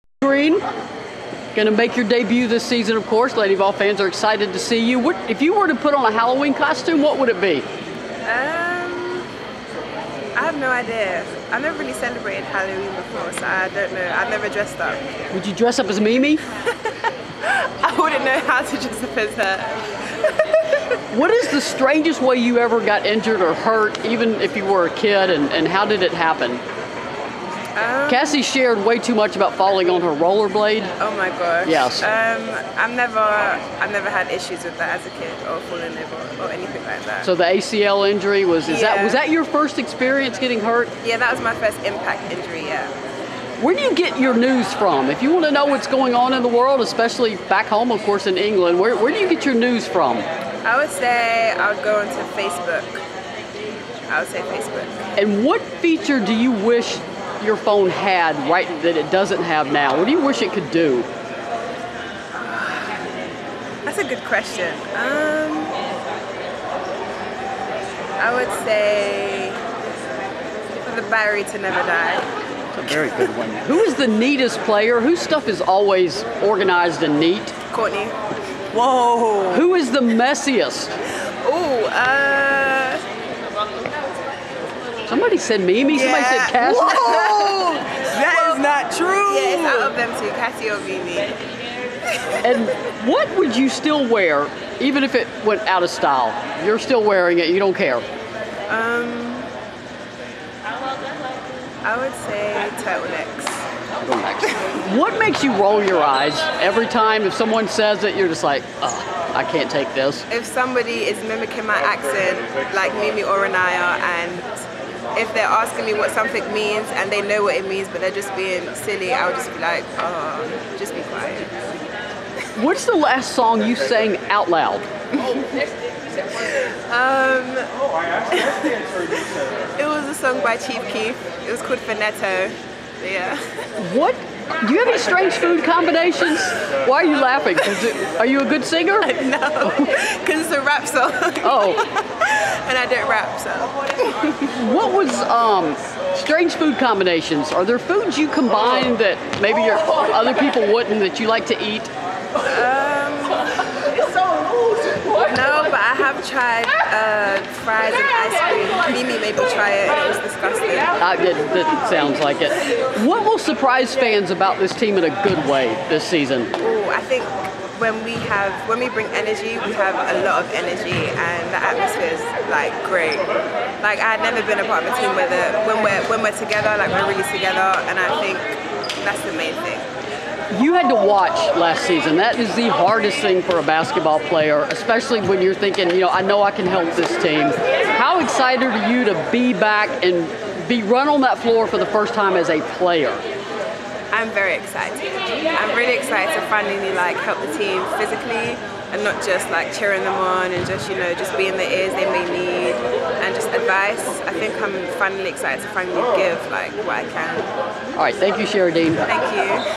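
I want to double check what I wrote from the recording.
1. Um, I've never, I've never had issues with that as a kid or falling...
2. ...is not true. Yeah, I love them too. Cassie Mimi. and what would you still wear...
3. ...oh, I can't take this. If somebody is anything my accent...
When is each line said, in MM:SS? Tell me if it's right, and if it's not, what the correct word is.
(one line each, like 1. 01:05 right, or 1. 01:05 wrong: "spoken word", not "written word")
1. 00:32 right
2. 01:28 right
3. 01:48 wrong: "mimicking", not "anything".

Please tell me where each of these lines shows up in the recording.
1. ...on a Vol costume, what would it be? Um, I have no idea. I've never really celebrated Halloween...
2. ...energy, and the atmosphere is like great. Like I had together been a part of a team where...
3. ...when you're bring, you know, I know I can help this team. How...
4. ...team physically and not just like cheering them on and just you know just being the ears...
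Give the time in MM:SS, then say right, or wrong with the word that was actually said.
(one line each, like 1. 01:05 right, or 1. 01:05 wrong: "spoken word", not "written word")
1. 00:05 wrong: "Halloween", not "Vol"
2. 02:50 wrong: "never", not "together"
3. 03:05 wrong: "thinking", not "bring"
4. 03:17 right.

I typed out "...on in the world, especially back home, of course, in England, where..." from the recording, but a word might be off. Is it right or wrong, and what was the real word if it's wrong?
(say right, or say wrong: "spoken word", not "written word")
right.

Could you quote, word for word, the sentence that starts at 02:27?
Are there foods you combine that maybe your, other people wouldn't that you like to eat?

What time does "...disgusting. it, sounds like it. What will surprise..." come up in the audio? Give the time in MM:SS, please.
02:40.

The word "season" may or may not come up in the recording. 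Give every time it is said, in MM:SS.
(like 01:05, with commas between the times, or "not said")
00:02, 02:46, 03:01.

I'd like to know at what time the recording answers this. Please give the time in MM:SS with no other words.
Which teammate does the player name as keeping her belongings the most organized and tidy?
01:17.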